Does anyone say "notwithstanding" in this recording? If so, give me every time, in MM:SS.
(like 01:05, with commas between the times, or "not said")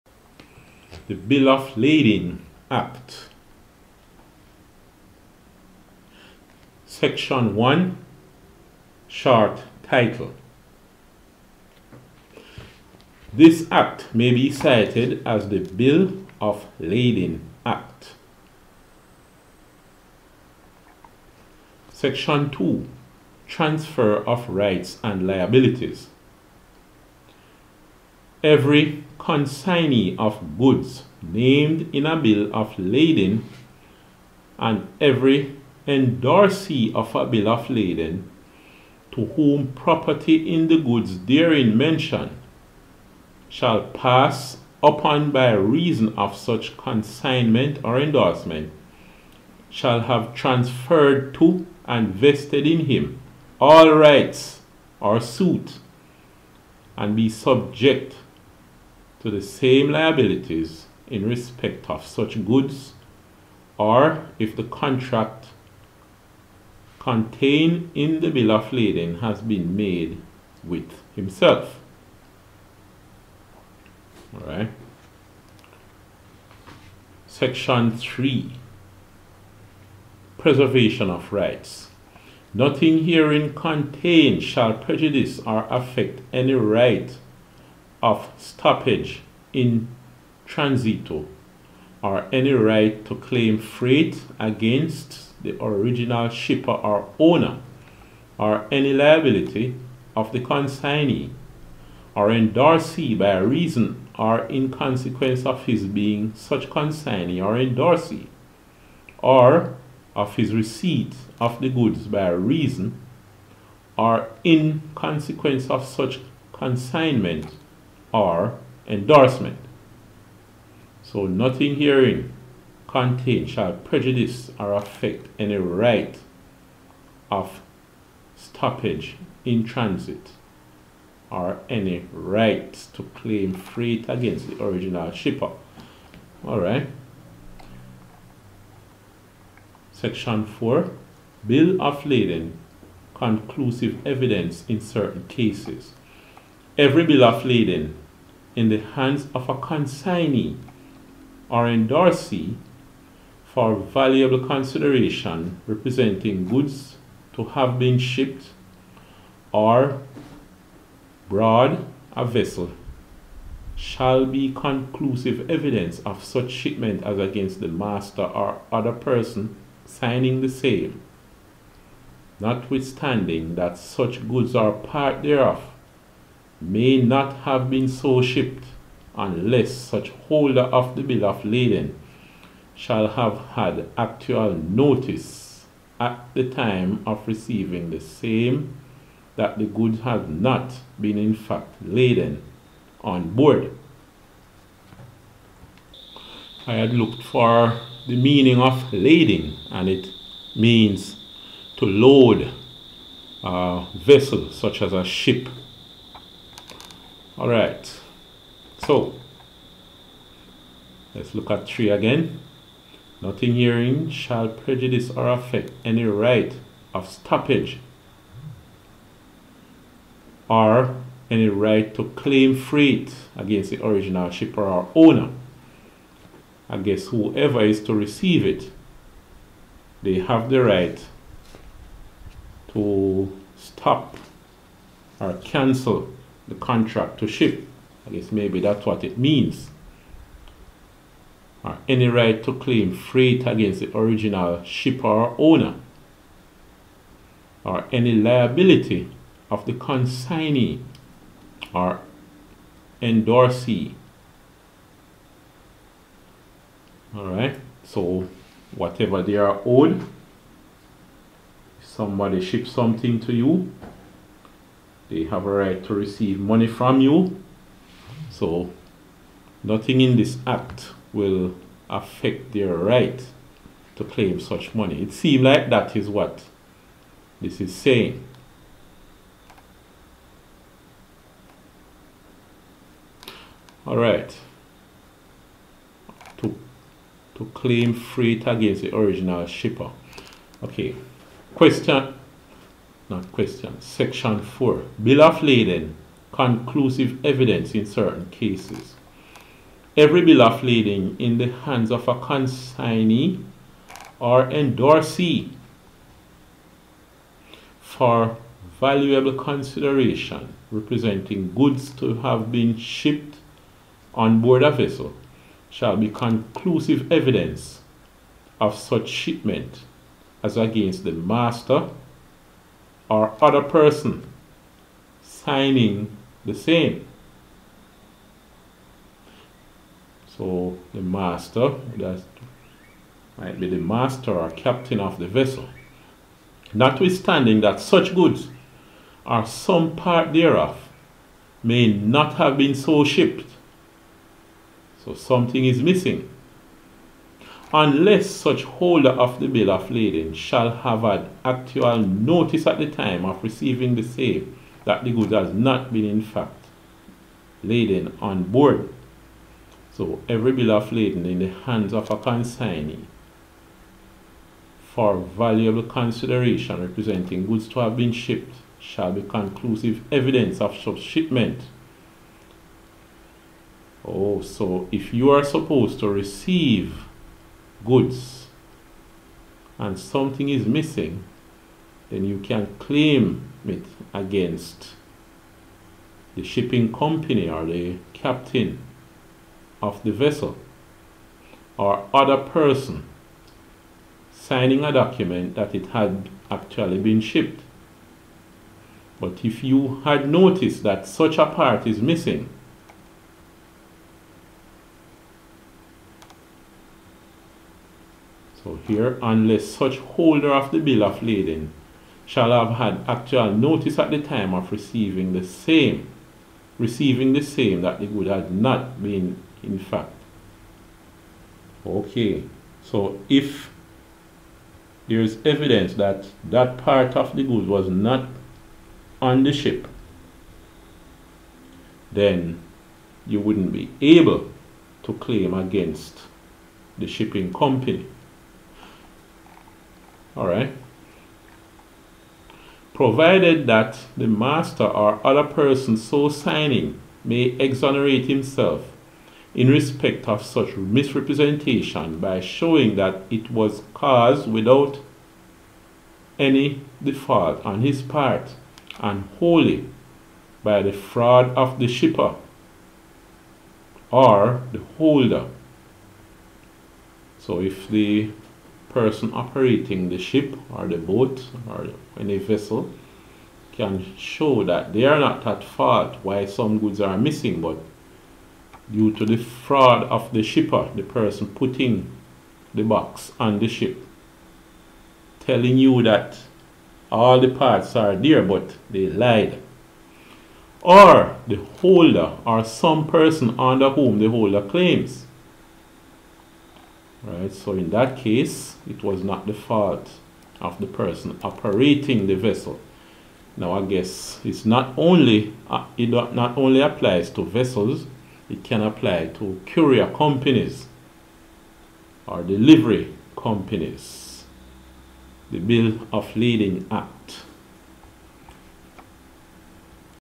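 02:52, 05:36.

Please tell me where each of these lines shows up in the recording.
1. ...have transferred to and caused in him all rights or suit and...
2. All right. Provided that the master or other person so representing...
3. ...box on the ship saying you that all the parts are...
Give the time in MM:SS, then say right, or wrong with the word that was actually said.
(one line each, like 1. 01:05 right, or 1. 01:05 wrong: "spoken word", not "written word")
1. 00:50 wrong: "vested", not "caused"
2. 07:20 wrong: "signing", not "representing"
3. 08:02 wrong: "telling", not "saying".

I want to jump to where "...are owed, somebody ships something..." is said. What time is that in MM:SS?
04:19.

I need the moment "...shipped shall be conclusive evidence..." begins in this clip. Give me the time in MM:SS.
06:08.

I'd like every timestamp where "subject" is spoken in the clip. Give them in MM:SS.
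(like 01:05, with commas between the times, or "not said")
00:57.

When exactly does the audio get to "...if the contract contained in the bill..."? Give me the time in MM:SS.
01:04.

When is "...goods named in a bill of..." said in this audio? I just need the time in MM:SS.
00:30.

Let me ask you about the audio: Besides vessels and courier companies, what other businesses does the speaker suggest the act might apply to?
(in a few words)
delivery companies.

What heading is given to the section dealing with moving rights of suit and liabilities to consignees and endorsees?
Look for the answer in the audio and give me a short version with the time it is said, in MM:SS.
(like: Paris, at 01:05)
Transfer of rights and liabilities, at 00:23.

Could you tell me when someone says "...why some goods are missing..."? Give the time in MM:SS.
07:56.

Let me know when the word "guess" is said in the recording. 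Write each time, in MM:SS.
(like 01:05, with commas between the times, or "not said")
03:58, 08:23.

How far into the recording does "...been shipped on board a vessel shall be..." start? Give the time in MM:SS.
05:12.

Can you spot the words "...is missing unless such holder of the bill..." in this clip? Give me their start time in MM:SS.
05:45.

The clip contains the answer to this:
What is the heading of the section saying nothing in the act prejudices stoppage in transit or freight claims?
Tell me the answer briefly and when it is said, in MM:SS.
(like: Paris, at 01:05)
Preservation of Rights, at 01:20.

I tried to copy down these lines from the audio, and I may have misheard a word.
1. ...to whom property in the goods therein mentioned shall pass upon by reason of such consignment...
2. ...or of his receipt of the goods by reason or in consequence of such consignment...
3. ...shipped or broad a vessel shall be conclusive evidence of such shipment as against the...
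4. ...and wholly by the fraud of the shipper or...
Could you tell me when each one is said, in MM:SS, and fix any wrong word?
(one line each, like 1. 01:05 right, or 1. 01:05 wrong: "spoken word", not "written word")
1. 00:39 right
2. 01:49 right
3. 02:37 right
4. 07:38 right.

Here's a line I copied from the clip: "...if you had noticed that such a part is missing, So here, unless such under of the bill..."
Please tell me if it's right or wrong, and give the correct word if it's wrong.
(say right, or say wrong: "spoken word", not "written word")
wrong: "holder", not "under".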